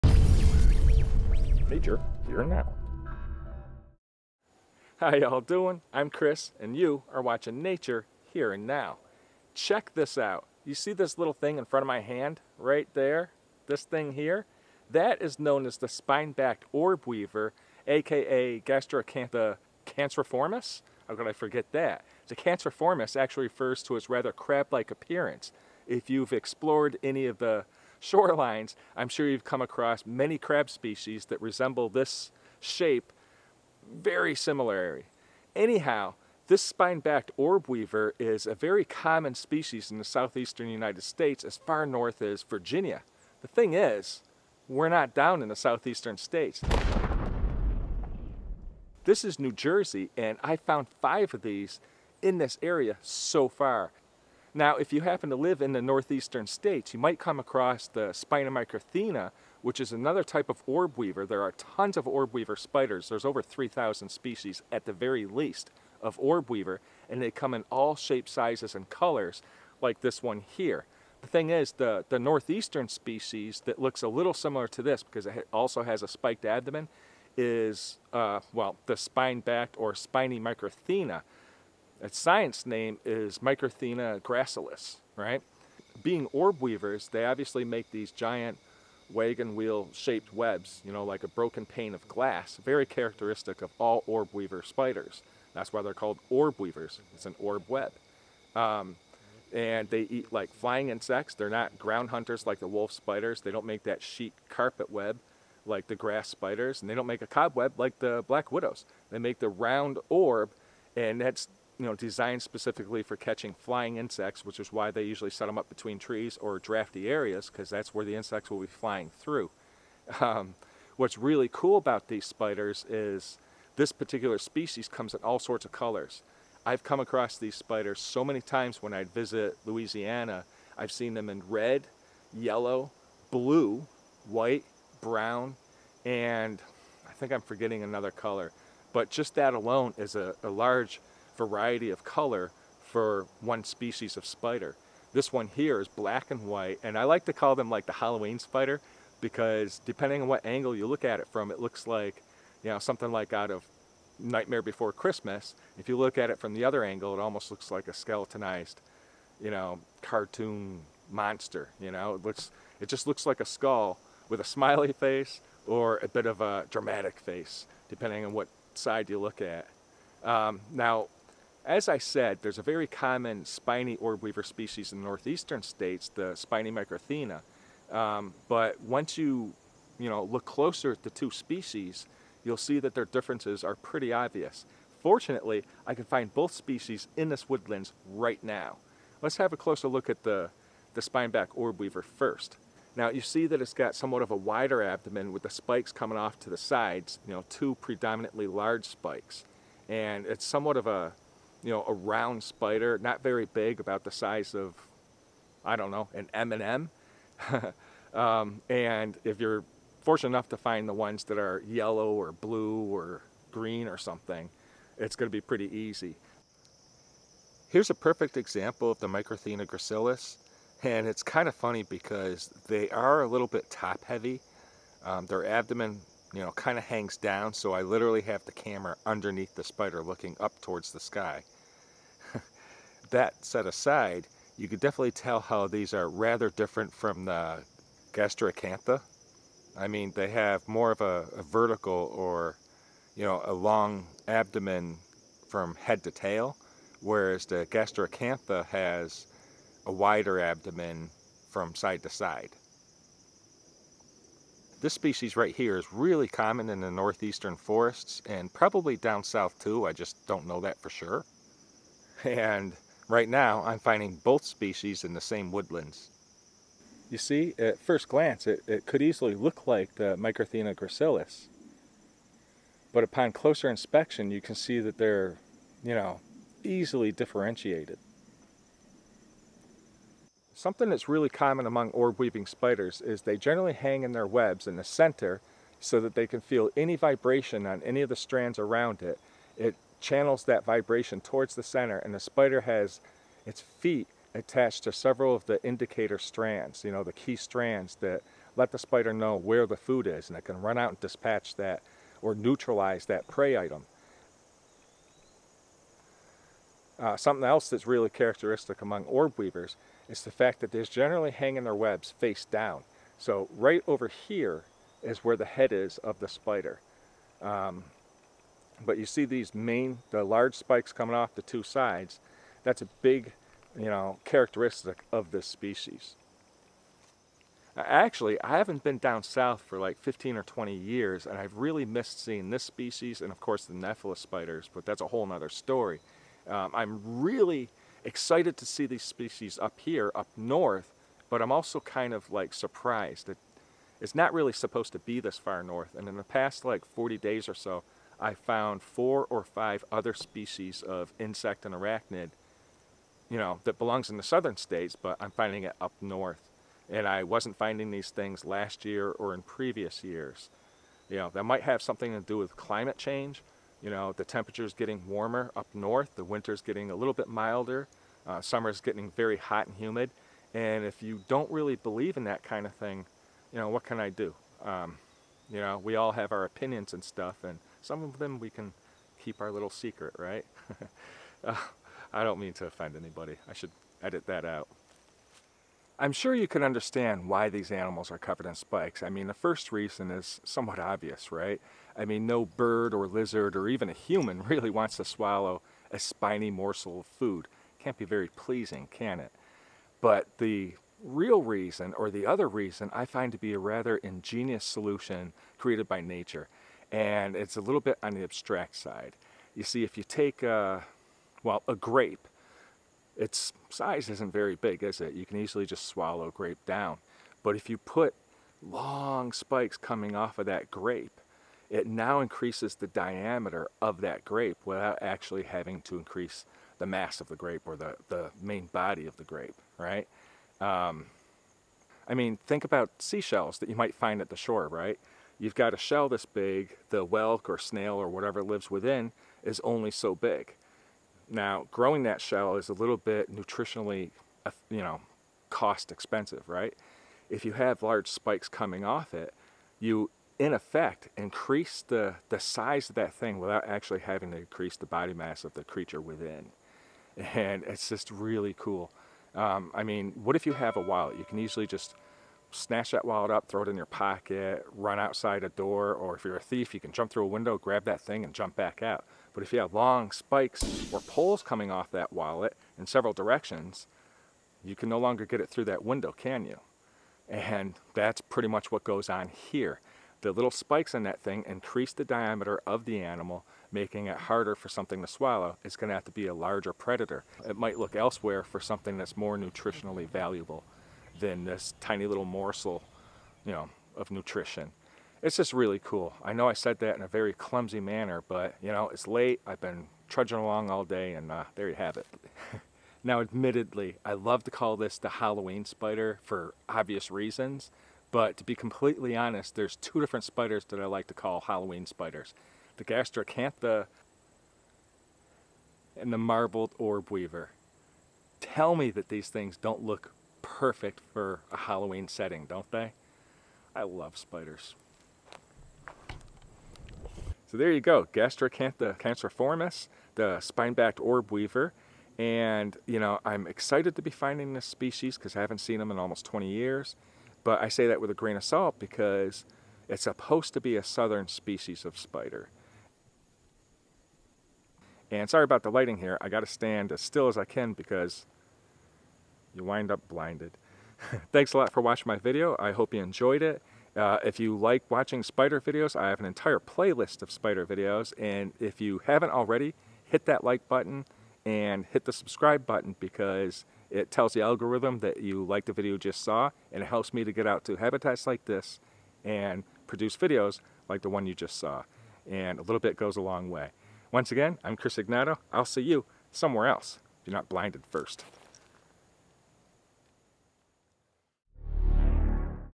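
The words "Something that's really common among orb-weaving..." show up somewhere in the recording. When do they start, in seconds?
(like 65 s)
280 s.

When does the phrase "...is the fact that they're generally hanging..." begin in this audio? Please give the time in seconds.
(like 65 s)
310 s.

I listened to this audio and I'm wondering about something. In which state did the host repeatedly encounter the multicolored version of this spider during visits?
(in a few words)
Louisiana.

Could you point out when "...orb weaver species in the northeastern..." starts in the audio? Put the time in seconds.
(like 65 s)
173 s.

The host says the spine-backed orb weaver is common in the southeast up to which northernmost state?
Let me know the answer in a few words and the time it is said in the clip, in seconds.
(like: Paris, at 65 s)
Virginia, at 42 s.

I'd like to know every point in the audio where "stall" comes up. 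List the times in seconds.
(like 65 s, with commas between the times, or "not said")
not said.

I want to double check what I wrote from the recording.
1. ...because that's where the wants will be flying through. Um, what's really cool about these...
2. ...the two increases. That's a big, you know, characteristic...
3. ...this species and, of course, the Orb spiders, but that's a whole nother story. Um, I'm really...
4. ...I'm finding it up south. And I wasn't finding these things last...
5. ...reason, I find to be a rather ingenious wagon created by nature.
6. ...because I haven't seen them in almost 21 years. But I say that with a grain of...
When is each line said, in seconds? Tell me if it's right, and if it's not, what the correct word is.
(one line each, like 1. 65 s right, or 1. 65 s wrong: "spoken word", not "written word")
1. 117 s wrong: "insects", not "wants"
2. 321 s wrong: "sides", not "increases"
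3. 332 s wrong: "Nephilis", not "Orb"
4. 355 s wrong: "north", not "south"
5. 402 s wrong: "solution", not "wagon"
6. 535 s wrong: "20", not "21".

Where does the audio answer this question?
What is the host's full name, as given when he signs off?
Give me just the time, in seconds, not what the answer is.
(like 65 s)
574 s.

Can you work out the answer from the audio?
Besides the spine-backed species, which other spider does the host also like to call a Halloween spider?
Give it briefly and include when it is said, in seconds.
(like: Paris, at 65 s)
Marbled Orb Weaver, at 516 s.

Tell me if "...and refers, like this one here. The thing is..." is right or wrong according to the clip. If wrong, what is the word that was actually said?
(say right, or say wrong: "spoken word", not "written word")
wrong: "colors", not "refers".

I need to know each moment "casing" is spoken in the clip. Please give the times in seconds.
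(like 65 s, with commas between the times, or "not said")
not said.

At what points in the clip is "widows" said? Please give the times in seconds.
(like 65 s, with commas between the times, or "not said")
108 s.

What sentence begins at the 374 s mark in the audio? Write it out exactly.
Um, you know, we all have our opinions and stuff, and some of them we can keep our little secret, right?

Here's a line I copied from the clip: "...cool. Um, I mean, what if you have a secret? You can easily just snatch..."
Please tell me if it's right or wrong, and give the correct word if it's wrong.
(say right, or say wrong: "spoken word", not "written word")
wrong: "wallet", not "secret".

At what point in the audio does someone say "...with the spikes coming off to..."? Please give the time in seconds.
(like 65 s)
195 s.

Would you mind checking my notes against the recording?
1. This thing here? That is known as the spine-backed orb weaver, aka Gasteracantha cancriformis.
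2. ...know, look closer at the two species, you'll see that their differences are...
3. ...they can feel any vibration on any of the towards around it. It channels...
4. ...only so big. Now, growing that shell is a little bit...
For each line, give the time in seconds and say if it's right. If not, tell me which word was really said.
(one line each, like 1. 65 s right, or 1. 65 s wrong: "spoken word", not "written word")
1. 13 s right
2. 180 s right
3. 286 s wrong: "strands", not "towards"
4. 439 s right.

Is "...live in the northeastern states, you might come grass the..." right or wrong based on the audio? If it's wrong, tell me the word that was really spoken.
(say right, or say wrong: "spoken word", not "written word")
wrong: "across", not "grass".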